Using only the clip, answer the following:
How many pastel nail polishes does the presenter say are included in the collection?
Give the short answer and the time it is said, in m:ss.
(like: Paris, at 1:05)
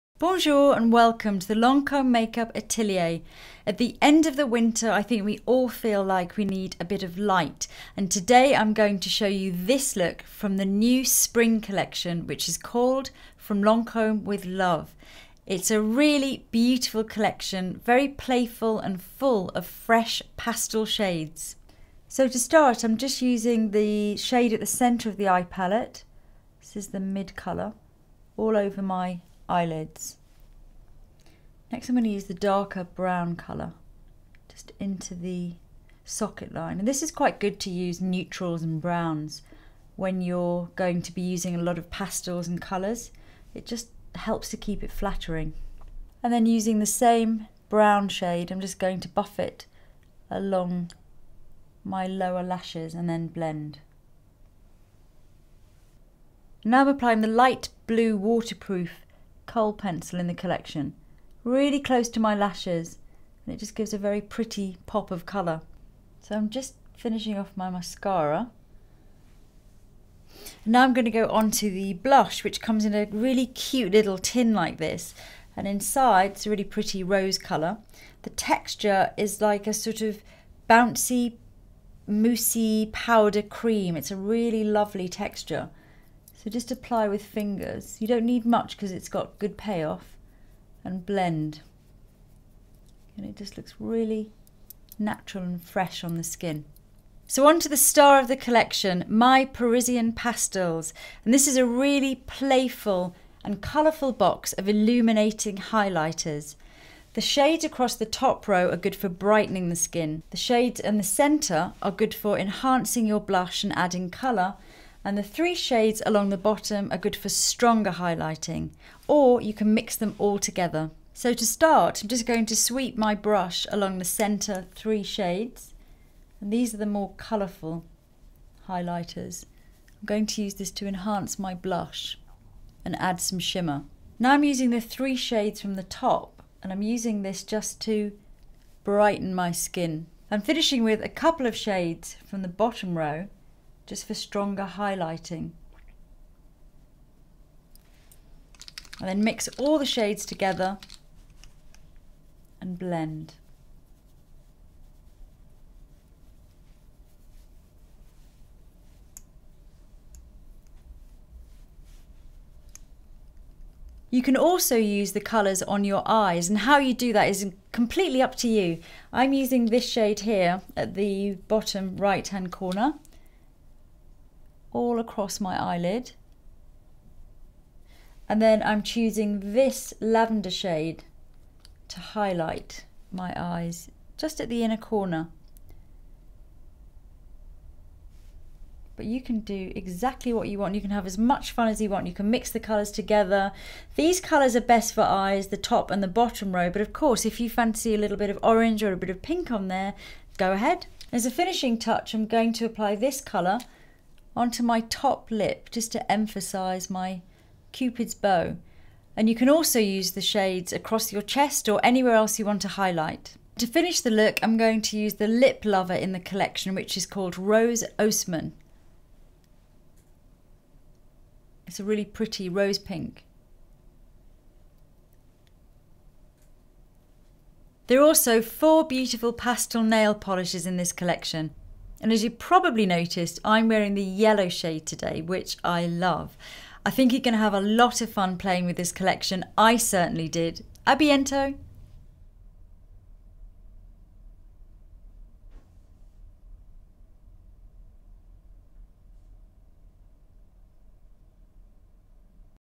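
4, at 3:48.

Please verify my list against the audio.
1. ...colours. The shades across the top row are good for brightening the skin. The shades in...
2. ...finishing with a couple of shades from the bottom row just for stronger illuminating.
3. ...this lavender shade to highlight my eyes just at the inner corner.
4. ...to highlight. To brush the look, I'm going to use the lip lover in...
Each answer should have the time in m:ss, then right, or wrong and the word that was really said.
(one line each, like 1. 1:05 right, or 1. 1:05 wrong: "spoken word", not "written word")
1. 1:45 wrong: "highlighters", not "colours"
2. 2:20 wrong: "highlighting", not "illuminating"
3. 2:59 right
4. 3:32 wrong: "finish", not "brush".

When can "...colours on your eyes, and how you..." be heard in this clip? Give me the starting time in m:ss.
2:45.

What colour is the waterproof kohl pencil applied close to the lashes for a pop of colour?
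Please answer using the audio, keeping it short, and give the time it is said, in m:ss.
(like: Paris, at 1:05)
Light blue, at 0:57.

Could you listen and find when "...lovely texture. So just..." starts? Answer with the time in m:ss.
1:24.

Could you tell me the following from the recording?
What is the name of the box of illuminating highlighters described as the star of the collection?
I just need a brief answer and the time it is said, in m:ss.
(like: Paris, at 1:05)
My Parisian Pastels, at 1:39.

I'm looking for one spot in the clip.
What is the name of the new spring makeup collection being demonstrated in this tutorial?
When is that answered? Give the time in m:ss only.
0:13.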